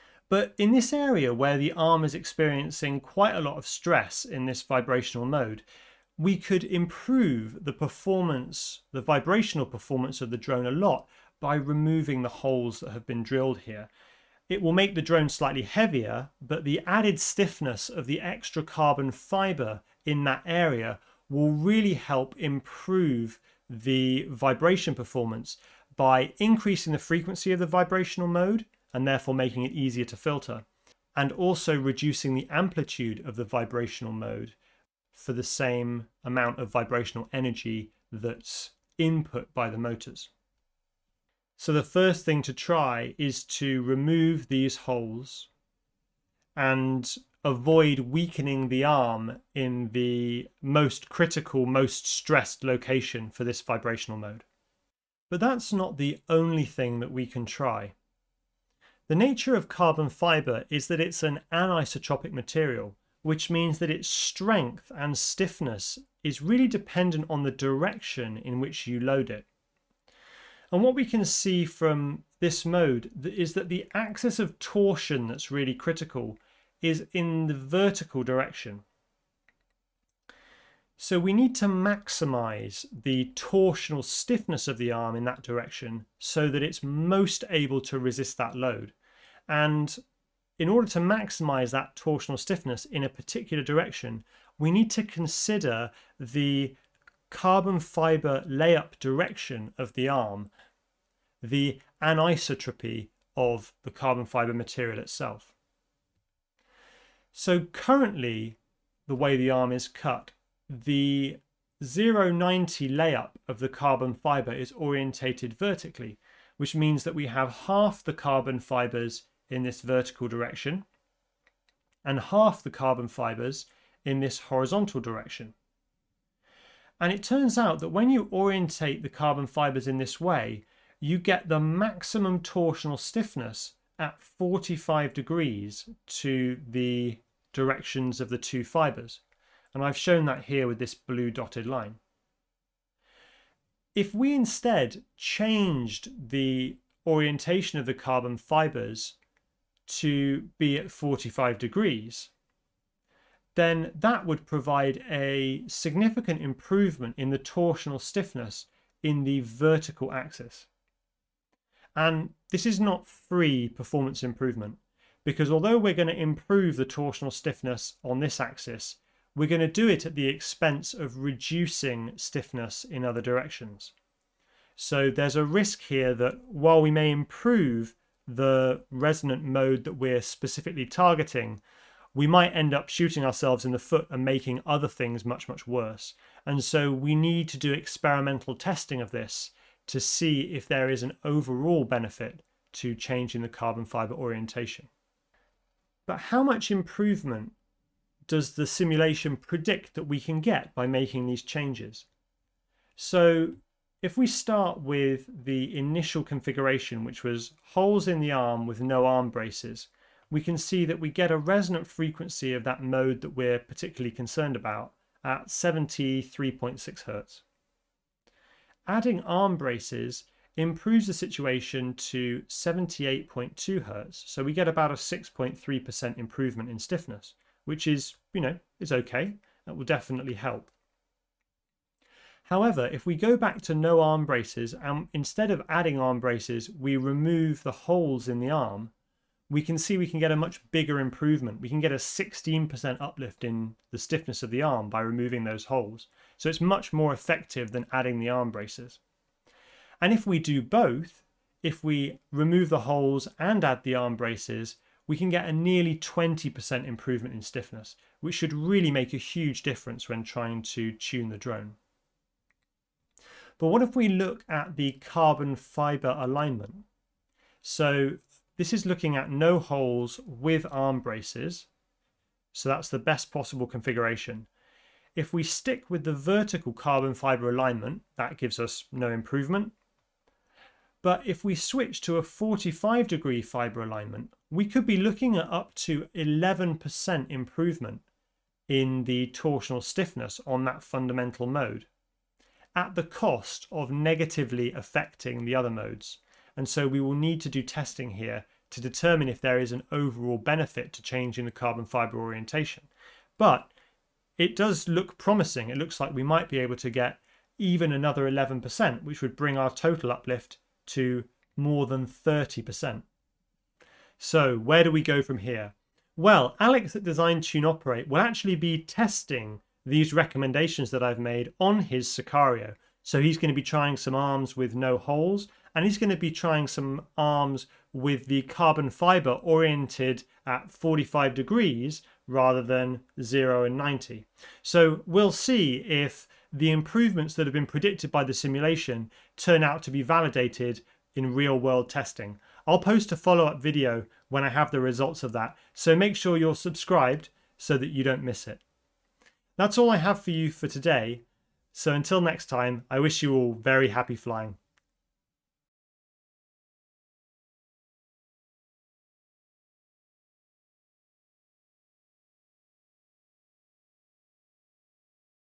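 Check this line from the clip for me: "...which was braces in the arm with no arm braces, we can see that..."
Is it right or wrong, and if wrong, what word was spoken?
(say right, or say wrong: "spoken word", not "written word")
wrong: "holes", not "braces".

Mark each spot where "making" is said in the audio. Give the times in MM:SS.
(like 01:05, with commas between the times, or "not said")
00:29, 03:04, 03:20.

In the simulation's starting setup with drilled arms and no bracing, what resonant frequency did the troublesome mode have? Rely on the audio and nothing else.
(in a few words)
73.6 Hz.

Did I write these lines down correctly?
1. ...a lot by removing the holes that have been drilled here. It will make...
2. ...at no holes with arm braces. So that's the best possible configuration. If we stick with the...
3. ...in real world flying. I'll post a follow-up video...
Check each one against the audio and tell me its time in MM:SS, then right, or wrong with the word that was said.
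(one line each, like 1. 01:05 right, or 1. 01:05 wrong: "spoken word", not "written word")
1. 00:10 right
2. 04:29 right
3. 05:41 wrong: "testing", not "flying".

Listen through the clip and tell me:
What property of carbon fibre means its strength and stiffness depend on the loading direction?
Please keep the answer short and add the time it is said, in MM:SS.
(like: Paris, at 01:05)
anisotropic, at 01:01.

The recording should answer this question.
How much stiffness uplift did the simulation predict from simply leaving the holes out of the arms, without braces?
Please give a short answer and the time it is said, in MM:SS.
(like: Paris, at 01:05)
16%, at 04:01.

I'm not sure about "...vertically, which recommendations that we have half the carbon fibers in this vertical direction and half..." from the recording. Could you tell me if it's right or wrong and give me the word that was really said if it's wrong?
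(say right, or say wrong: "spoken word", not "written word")
wrong: "means", not "recommendations".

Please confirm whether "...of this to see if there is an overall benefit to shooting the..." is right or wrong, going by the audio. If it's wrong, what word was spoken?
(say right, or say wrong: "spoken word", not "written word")
wrong: "changing", not "shooting".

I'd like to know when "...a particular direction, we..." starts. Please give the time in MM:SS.
01:33.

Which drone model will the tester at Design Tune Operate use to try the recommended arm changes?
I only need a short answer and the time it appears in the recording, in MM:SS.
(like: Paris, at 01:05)
Siccario, at 05:22.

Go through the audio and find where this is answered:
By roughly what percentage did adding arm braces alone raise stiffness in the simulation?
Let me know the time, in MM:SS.
03:44.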